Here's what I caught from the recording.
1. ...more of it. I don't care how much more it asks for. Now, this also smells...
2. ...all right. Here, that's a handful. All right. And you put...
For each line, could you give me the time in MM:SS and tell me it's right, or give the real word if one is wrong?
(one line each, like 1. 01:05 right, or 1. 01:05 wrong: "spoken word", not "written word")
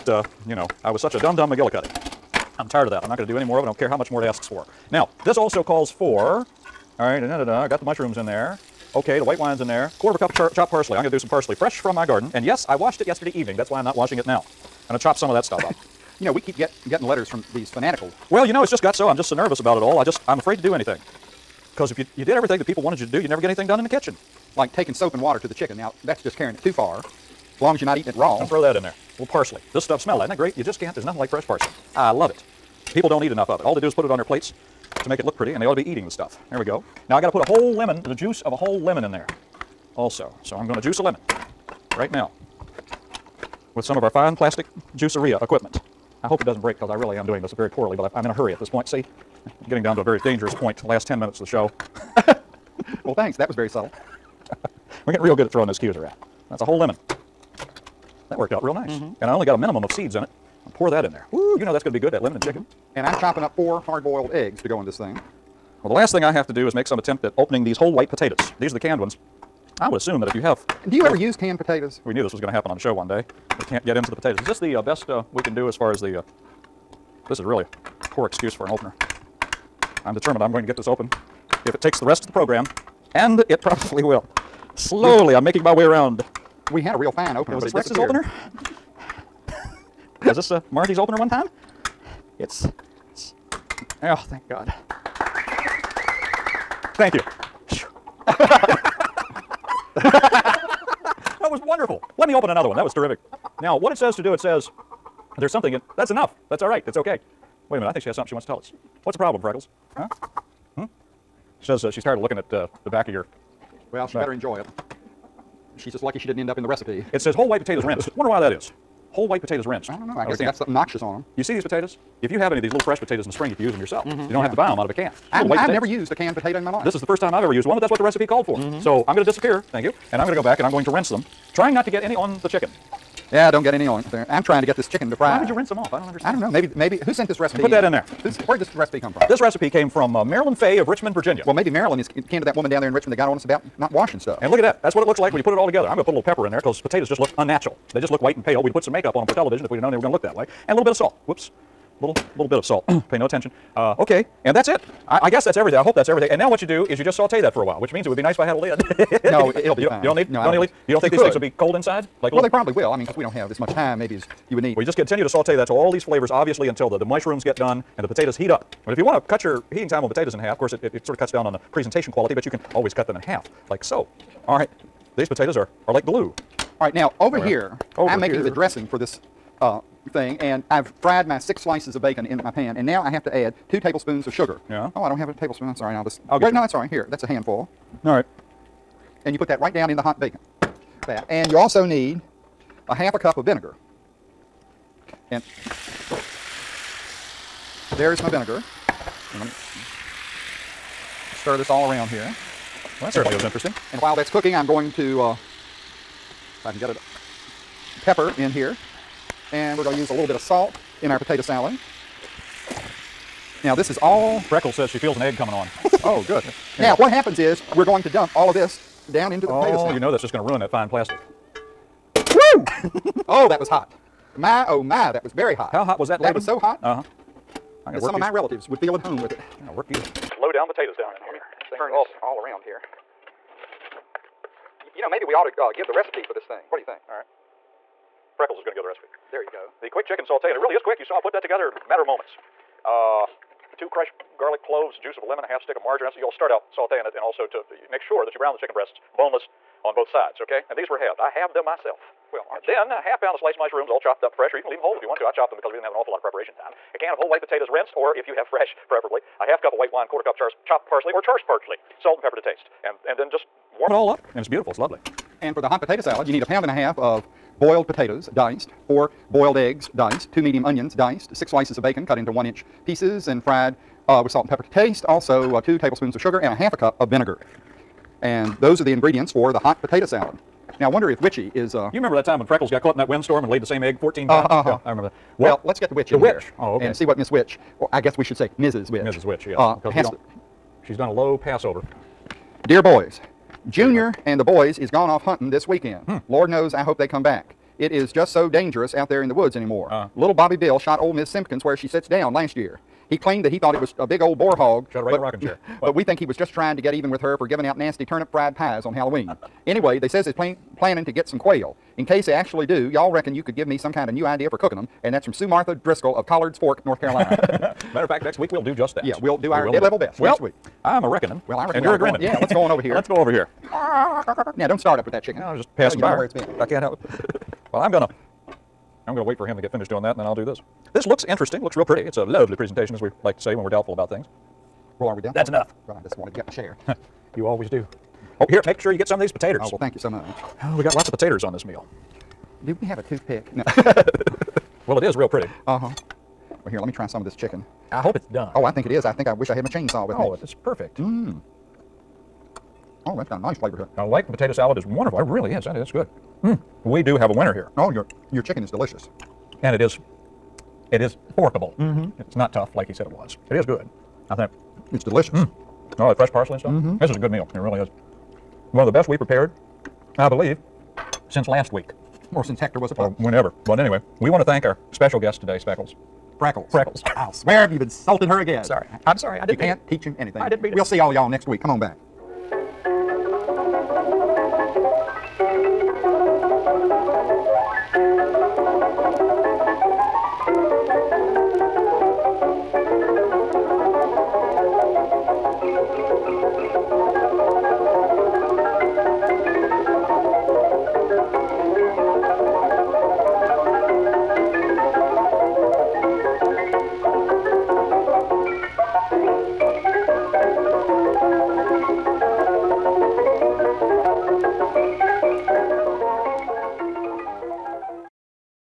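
1. 00:03 wrong: "calls", not "smells"
2. 03:06 right.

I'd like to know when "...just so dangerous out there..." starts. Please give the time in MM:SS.
04:58.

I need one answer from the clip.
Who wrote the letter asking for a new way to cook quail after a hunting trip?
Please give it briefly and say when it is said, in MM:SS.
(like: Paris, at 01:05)
Sue Martha Driscoll, at 05:15.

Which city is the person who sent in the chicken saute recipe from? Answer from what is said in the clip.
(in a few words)
Richmond, Virginia.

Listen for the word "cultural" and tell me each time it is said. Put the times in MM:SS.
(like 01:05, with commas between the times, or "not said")
not said.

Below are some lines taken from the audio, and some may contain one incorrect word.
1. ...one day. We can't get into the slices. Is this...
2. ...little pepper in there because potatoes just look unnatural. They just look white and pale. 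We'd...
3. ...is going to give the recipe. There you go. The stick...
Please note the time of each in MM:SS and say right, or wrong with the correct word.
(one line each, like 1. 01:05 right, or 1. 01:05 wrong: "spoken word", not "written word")
1. 01:12 wrong: "potatoes", not "slices"
2. 02:26 right
3. 03:58 wrong: "quick", not "stick".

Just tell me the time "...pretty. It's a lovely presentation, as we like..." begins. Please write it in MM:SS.
05:31.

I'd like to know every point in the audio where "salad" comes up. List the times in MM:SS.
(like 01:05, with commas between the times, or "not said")
03:31, 03:39, 04:25, 04:40, 05:54.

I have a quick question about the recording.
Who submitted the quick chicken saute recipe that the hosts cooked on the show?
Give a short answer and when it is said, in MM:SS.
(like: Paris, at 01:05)
Marilyn Fay, at 02:20.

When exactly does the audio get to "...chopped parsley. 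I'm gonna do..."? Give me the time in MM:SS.
00:10.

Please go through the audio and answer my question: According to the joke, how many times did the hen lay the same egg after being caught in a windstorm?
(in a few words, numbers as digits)
14.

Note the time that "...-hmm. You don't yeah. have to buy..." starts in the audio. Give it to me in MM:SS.
02:04.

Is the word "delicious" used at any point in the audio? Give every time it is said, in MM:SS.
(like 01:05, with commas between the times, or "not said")
05:58, 06:05.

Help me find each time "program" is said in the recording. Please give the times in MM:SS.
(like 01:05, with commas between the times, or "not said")
01:22.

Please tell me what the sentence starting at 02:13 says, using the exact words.
Yeah, don't get any on there.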